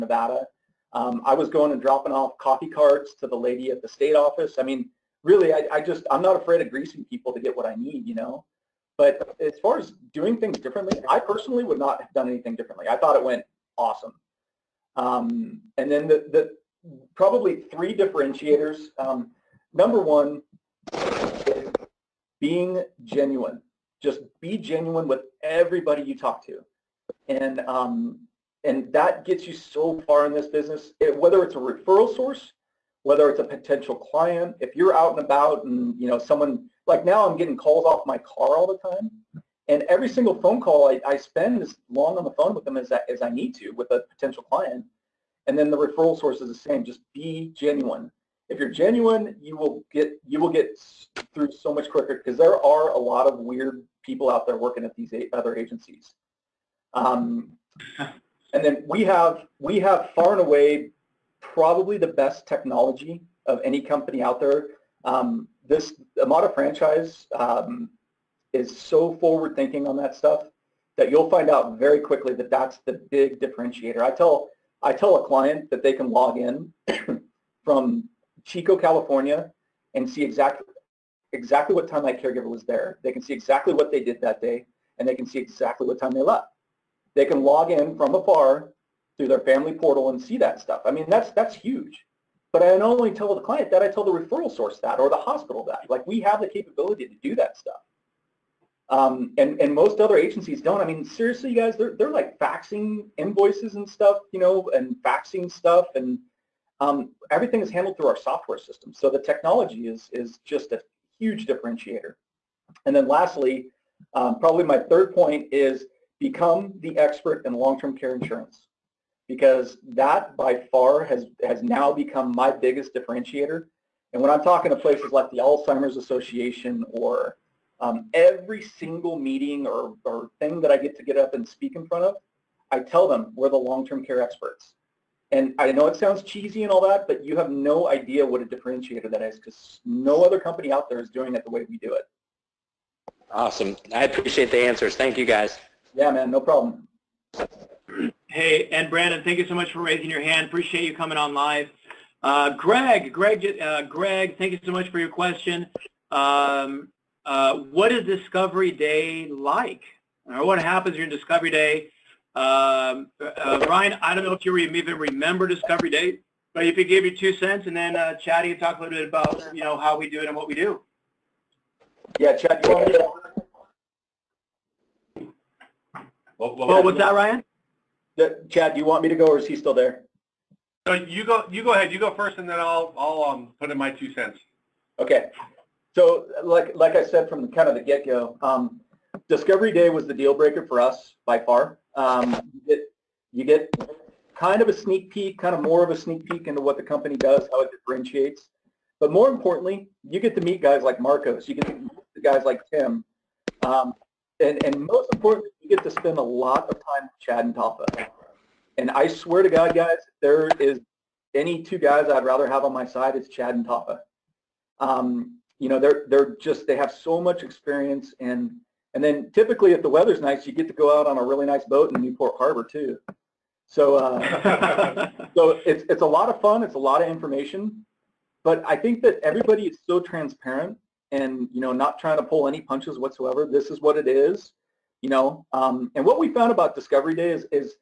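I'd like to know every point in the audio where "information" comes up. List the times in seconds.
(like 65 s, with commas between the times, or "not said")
227 s.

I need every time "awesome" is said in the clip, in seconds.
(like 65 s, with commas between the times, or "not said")
13 s, 143 s.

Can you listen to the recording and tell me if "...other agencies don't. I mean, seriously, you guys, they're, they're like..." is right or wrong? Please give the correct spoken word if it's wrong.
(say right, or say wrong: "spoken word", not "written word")
right.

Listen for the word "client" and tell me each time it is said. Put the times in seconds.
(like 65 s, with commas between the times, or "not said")
33 s, 44 s, 75 s, 93 s.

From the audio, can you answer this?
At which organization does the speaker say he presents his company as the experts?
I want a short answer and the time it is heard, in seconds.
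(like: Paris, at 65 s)
Alzheimer's Association, at 125 s.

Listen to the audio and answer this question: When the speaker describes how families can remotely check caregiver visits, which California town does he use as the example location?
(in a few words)
Chico.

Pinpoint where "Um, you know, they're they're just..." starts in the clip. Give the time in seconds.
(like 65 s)
214 s.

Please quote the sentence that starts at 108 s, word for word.
So the technology is, is just a huge differentiator.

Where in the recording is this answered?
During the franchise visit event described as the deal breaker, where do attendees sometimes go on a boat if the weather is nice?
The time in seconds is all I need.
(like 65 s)
222 s.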